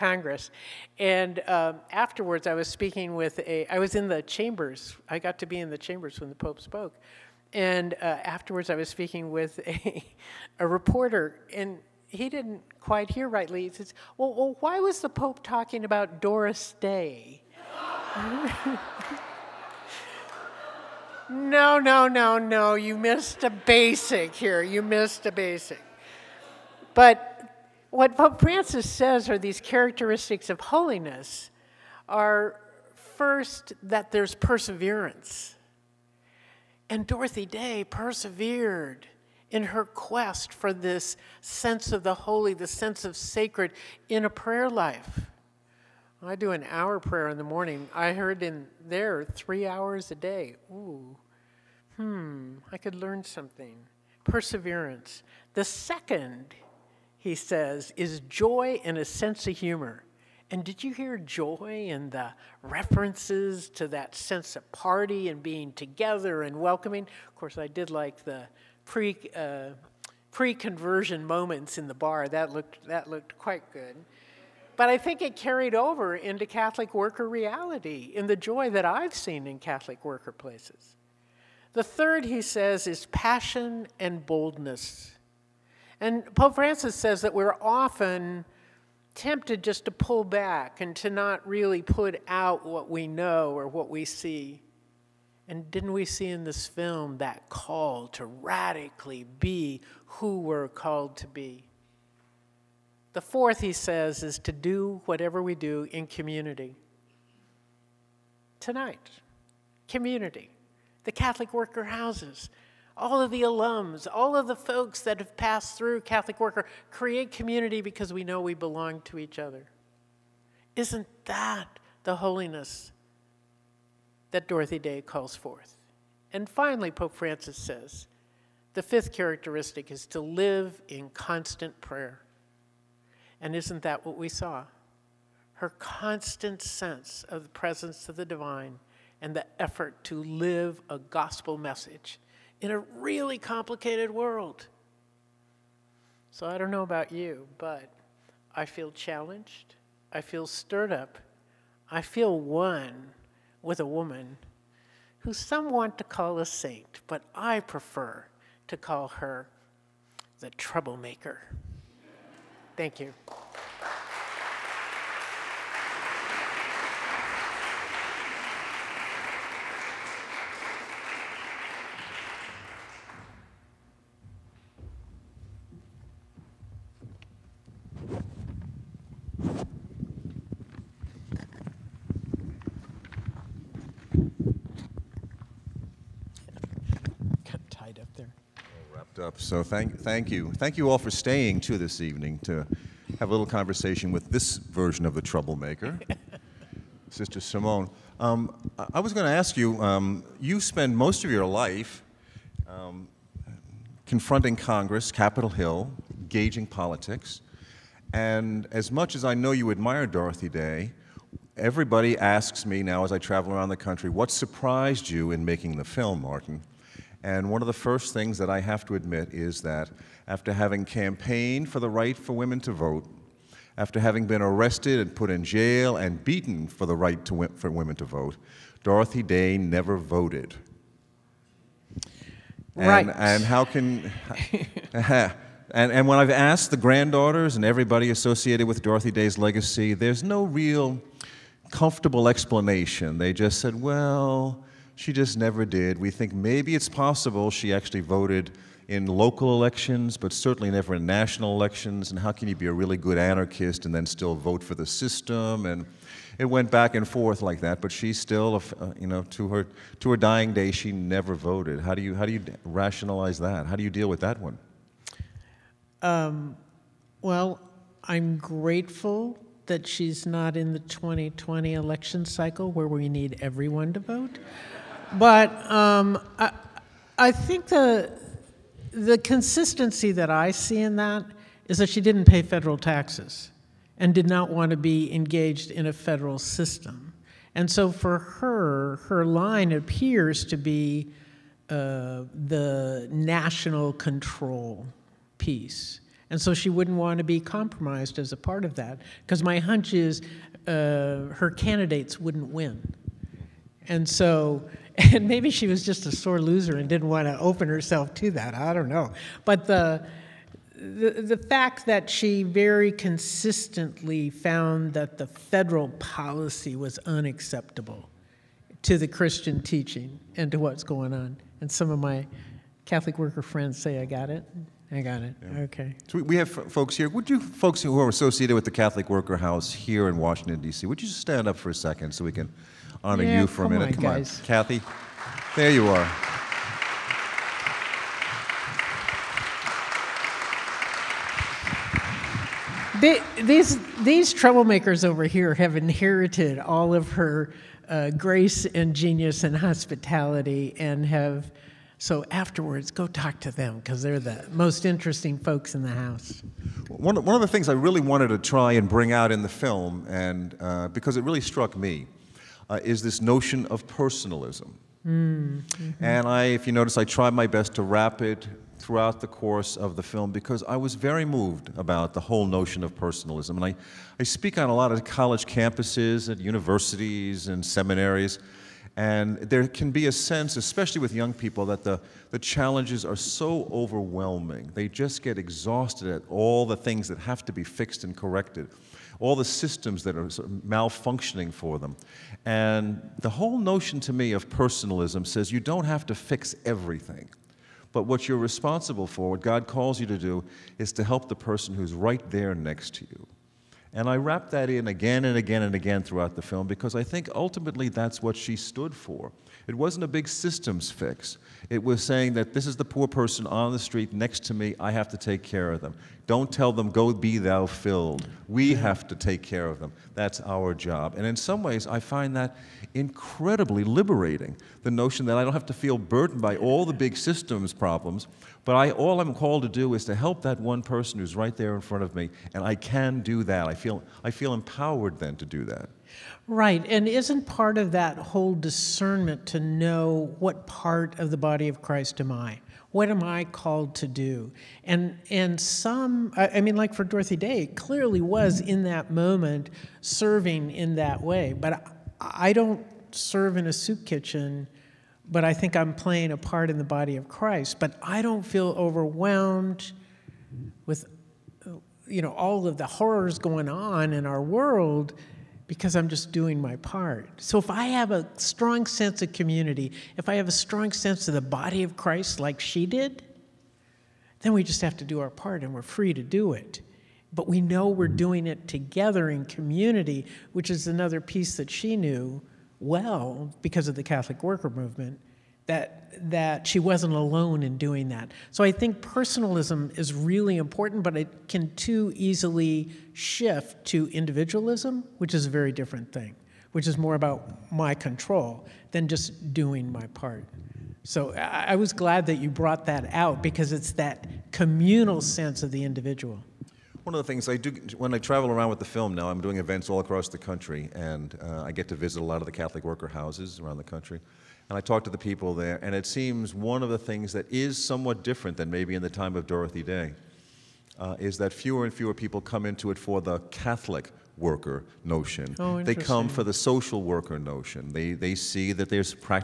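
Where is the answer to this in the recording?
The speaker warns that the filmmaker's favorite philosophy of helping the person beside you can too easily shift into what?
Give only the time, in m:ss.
8:14.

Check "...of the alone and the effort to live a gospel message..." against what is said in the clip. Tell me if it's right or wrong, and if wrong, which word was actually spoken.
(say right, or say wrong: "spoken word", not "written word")
wrong: "divine", not "alone".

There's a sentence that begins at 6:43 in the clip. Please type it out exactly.
And I wrap that in again and again and again throughout the film because I think ultimately that's what she stood for.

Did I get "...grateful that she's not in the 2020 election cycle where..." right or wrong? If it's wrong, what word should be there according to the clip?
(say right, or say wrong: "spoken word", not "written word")
right.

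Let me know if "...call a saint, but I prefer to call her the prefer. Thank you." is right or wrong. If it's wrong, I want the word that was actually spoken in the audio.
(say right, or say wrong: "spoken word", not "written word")
wrong: "troublemaker", not "prefer".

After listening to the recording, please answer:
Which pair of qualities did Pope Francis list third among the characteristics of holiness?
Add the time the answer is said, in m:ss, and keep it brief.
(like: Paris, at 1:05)
passion and boldness, at 1:23.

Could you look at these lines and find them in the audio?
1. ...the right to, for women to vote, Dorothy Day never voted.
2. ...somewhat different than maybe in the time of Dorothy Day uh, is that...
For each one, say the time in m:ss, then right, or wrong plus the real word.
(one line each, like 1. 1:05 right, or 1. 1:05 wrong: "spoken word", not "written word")
1. 3:46 right
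2. 8:37 right.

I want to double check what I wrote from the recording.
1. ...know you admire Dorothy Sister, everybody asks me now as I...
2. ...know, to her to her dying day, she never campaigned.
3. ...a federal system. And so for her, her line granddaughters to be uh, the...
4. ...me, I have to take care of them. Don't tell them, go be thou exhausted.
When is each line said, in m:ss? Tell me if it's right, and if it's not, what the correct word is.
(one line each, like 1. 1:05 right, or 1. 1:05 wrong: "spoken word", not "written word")
1. 3:29 wrong: "Day", not "Sister"
2. 4:19 wrong: "voted", not "campaigned"
3. 4:45 wrong: "appears", not "granddaughters"
4. 6:54 wrong: "filled", not "exhausted".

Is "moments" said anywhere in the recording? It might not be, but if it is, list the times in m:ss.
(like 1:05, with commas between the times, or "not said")
1:11, 7:29.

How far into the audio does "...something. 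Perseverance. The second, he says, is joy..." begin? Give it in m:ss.
0:53.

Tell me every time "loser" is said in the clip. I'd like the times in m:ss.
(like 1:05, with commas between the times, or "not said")
5:06.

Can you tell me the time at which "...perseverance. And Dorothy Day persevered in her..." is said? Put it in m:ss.
0:34.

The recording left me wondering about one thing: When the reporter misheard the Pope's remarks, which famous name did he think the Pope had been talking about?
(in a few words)
Doris Day.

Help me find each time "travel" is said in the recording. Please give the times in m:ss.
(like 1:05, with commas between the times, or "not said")
3:33, 8:28.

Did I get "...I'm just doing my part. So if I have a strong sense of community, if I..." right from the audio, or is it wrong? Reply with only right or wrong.
right.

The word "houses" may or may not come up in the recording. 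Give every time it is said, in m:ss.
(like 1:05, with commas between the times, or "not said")
1:51, 5:29, 5:55, 8:33.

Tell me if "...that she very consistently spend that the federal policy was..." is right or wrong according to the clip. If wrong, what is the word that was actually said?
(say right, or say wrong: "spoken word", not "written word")
wrong: "found", not "spend".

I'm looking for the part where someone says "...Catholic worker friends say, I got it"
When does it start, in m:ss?
5:22.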